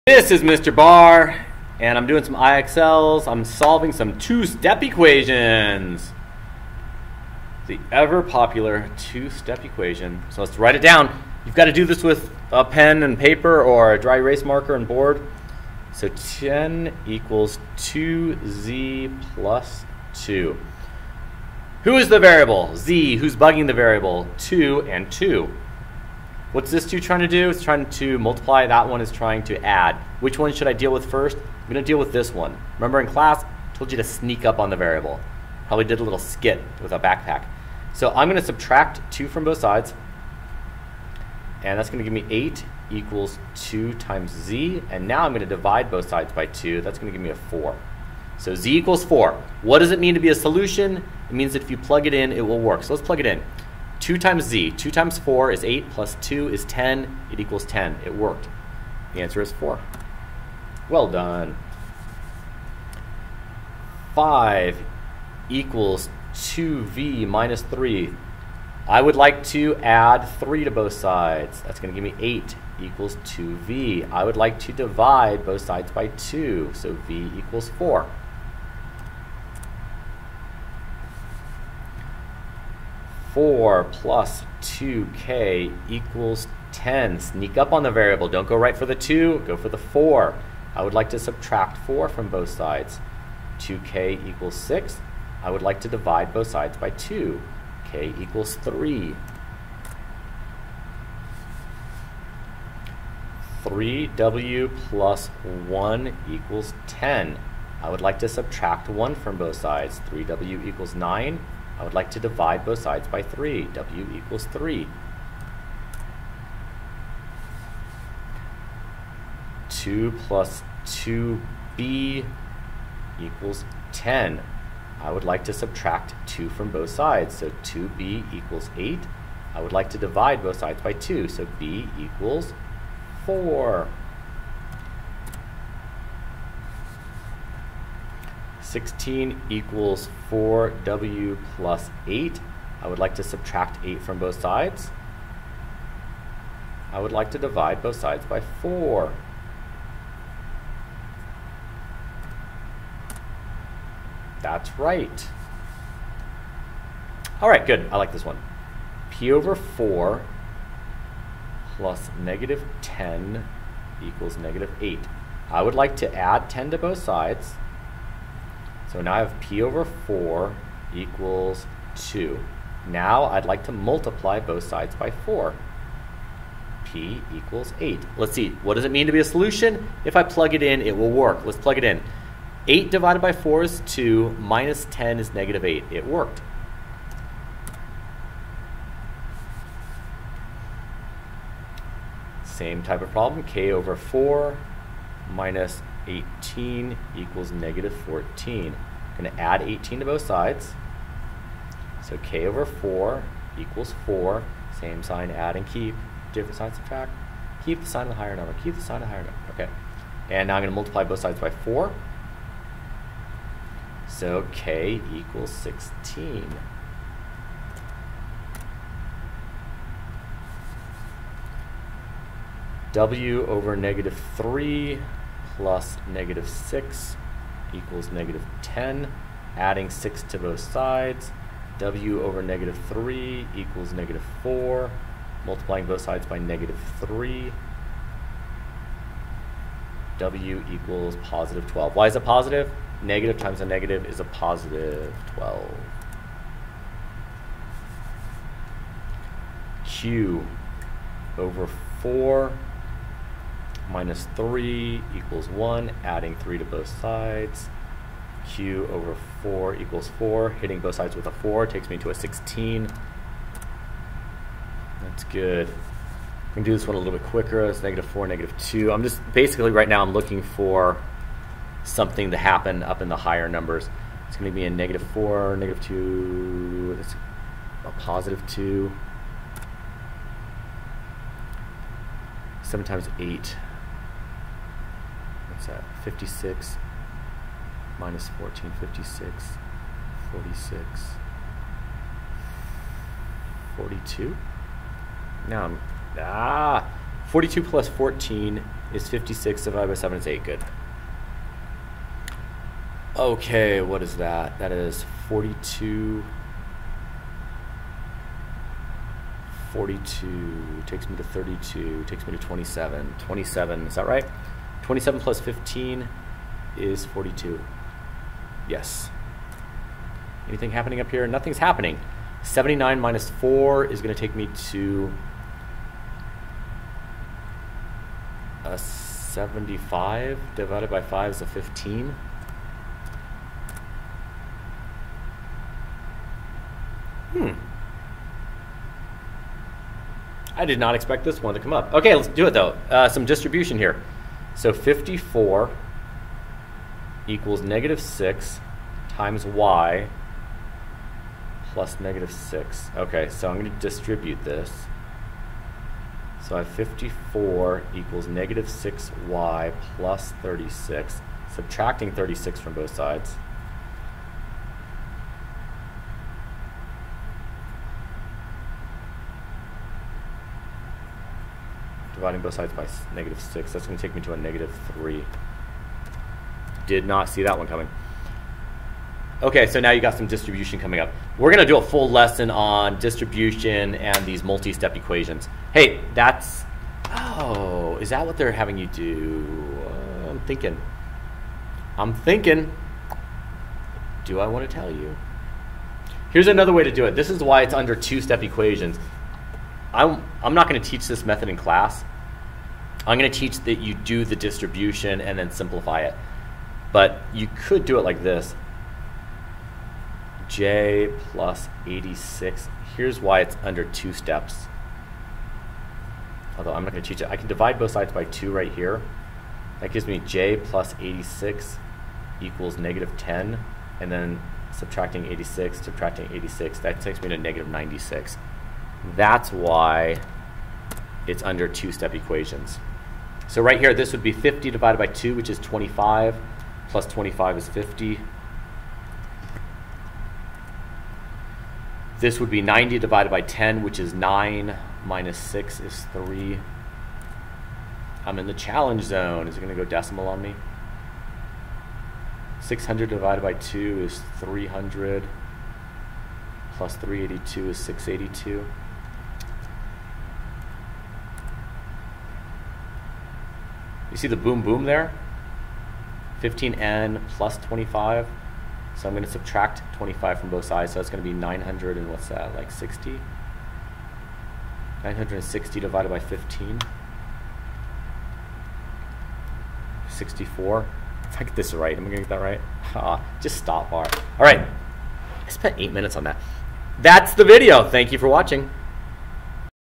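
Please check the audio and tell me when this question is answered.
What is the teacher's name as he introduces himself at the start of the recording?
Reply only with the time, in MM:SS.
00:00.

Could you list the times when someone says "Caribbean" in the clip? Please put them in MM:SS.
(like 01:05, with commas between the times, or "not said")
not said.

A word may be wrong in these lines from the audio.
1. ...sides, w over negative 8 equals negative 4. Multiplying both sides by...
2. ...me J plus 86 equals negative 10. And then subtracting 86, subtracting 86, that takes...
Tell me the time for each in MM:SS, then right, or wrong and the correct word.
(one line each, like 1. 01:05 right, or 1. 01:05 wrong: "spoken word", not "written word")
1. 03:50 wrong: "3", not "8"
2. 07:00 right.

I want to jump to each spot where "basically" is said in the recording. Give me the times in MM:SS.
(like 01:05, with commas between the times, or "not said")
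04:29.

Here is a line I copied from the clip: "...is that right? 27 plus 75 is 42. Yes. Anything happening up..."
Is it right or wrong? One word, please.
wrong.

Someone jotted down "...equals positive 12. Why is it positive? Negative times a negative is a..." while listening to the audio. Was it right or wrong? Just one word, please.
right.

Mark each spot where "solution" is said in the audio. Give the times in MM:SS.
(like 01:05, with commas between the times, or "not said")
00:50, 02:59.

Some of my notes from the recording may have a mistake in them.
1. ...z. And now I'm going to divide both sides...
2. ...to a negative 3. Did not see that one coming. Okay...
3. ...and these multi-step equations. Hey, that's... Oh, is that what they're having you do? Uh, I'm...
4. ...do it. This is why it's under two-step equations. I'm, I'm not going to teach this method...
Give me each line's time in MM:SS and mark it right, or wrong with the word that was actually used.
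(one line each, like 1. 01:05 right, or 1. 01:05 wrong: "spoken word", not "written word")
1. 00:44 right
2. 06:14 right
3. 06:23 right
4. 06:36 right.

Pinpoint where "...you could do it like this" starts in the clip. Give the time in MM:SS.
06:47.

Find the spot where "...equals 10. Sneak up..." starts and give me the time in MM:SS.
01:25.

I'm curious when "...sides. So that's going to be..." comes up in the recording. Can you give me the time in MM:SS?
07:50.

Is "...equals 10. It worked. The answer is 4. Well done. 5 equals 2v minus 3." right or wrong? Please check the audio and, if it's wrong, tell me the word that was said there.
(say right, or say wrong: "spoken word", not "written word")
right.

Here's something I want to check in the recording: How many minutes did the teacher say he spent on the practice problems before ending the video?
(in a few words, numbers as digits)
8.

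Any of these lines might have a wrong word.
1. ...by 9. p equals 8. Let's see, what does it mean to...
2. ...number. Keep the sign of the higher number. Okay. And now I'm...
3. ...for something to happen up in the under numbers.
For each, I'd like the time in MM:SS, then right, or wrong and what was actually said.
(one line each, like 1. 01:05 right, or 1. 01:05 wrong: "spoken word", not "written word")
1. 02:54 wrong: "4", not "9"
2. 03:28 right
3. 04:30 wrong: "higher", not "under".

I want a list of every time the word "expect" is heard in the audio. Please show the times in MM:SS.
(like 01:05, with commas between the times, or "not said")
05:40.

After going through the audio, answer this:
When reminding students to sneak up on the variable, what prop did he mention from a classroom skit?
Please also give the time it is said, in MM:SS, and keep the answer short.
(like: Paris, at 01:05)
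backpack, at 00:36.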